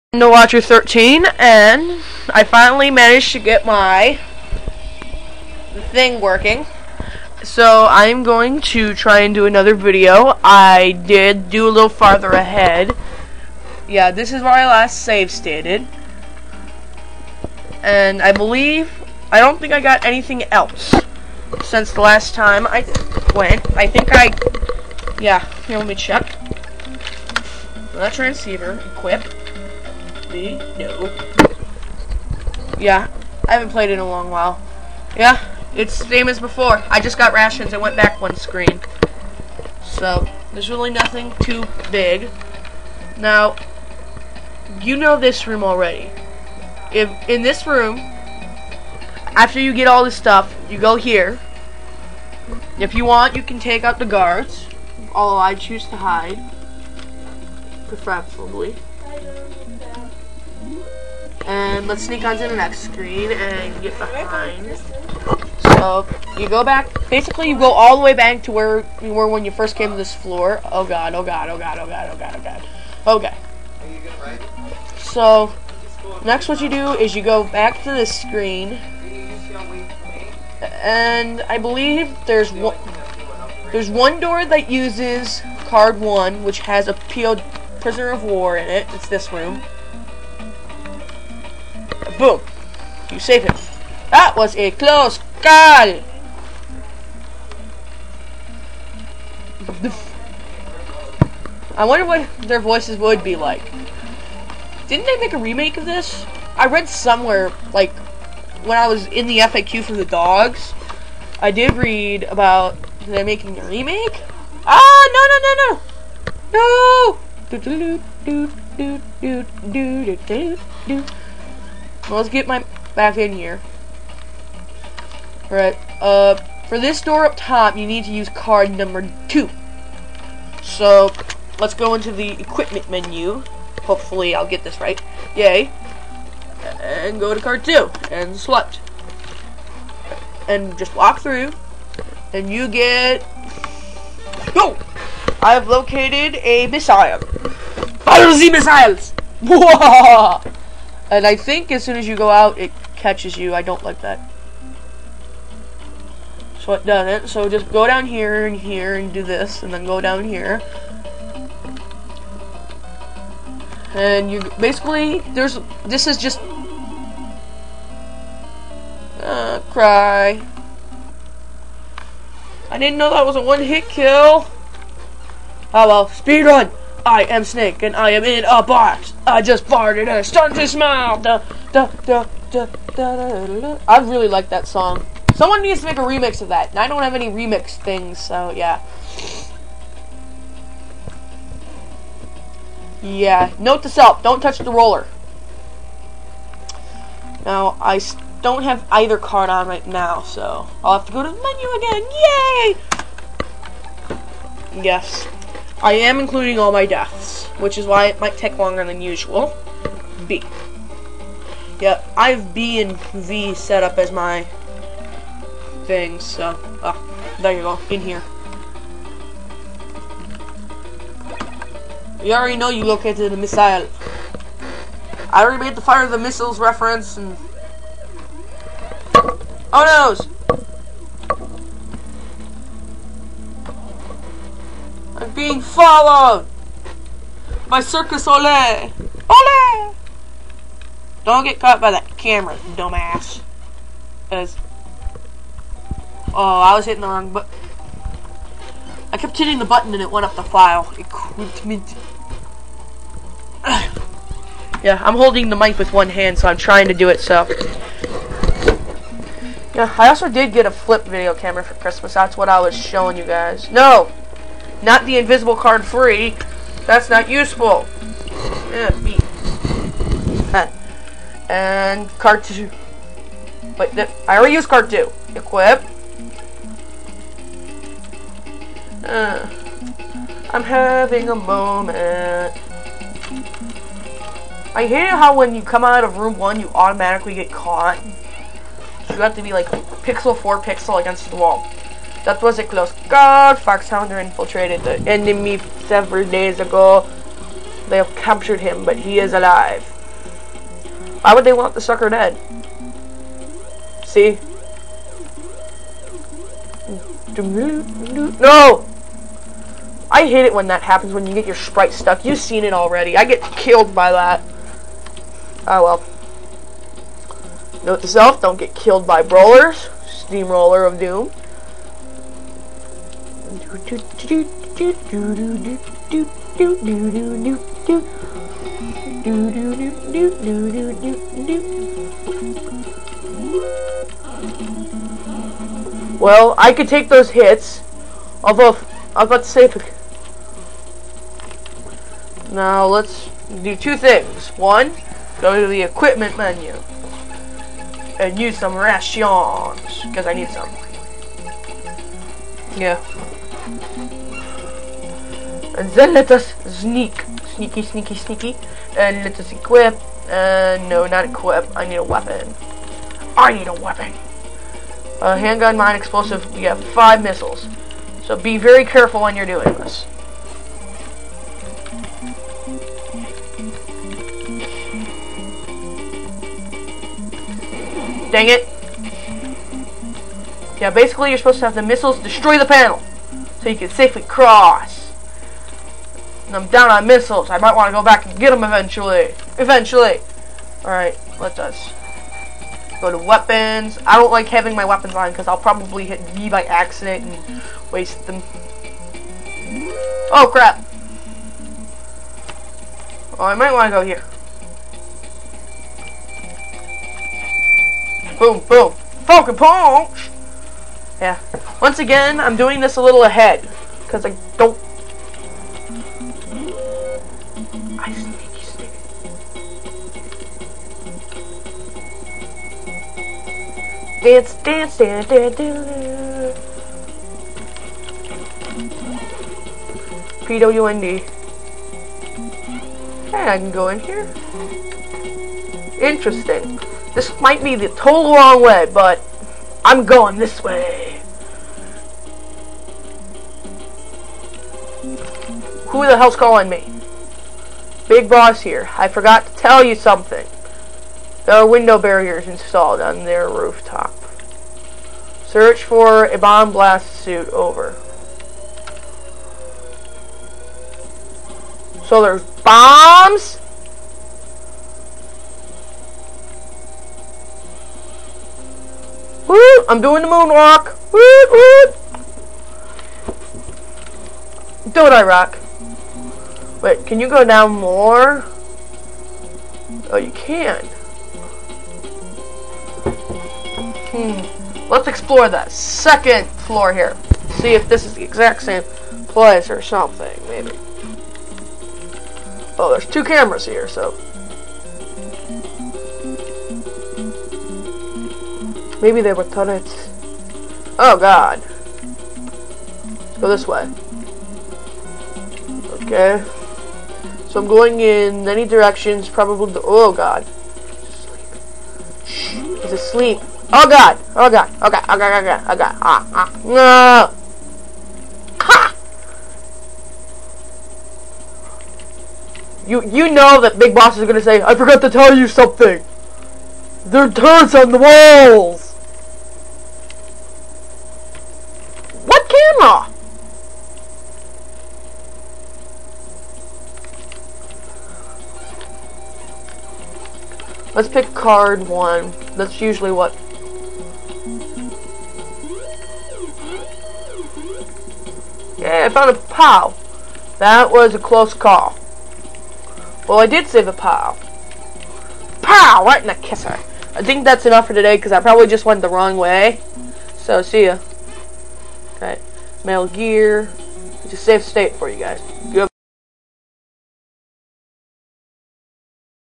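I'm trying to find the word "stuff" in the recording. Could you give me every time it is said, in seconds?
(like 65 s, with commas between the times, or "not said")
50 s.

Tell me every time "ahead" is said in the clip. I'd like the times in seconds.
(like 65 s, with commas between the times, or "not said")
12 s, 413 s.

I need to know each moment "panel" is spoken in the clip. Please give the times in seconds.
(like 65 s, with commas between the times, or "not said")
382 s.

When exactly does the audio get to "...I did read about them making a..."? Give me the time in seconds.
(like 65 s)
111 s.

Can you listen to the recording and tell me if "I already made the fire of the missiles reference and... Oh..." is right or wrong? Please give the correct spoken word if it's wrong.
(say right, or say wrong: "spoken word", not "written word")
right.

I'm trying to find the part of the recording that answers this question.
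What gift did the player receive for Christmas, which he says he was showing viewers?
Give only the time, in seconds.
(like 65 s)
260 s.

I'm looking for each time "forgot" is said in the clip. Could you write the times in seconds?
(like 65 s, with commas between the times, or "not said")
449 s, 524 s.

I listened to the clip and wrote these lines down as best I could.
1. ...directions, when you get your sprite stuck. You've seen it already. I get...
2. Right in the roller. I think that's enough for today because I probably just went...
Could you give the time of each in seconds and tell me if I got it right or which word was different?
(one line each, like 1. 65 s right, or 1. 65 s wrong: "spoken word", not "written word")
1. 310 s wrong: "happens", not "directions"
2. 556 s wrong: "kisser", not "roller".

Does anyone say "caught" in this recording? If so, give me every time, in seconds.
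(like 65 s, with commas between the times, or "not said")
241 s, 287 s.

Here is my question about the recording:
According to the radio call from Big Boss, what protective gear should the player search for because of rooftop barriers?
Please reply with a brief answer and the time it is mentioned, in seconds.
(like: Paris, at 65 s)
bomb blast suit, at 456 s.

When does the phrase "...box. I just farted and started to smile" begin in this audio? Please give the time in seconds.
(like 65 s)
178 s.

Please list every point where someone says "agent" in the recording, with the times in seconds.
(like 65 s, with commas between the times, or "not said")
not said.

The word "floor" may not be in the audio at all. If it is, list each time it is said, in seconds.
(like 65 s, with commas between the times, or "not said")
70 s, 486 s.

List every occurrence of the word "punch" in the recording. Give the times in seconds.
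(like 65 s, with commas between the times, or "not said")
409 s.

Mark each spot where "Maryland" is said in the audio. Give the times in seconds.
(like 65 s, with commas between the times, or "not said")
not said.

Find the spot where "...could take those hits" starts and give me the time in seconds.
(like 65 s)
336 s.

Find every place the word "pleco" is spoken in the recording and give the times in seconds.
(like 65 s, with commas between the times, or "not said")
not said.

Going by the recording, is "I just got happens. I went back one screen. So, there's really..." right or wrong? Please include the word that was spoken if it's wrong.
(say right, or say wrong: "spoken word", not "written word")
wrong: "rations", not "happens".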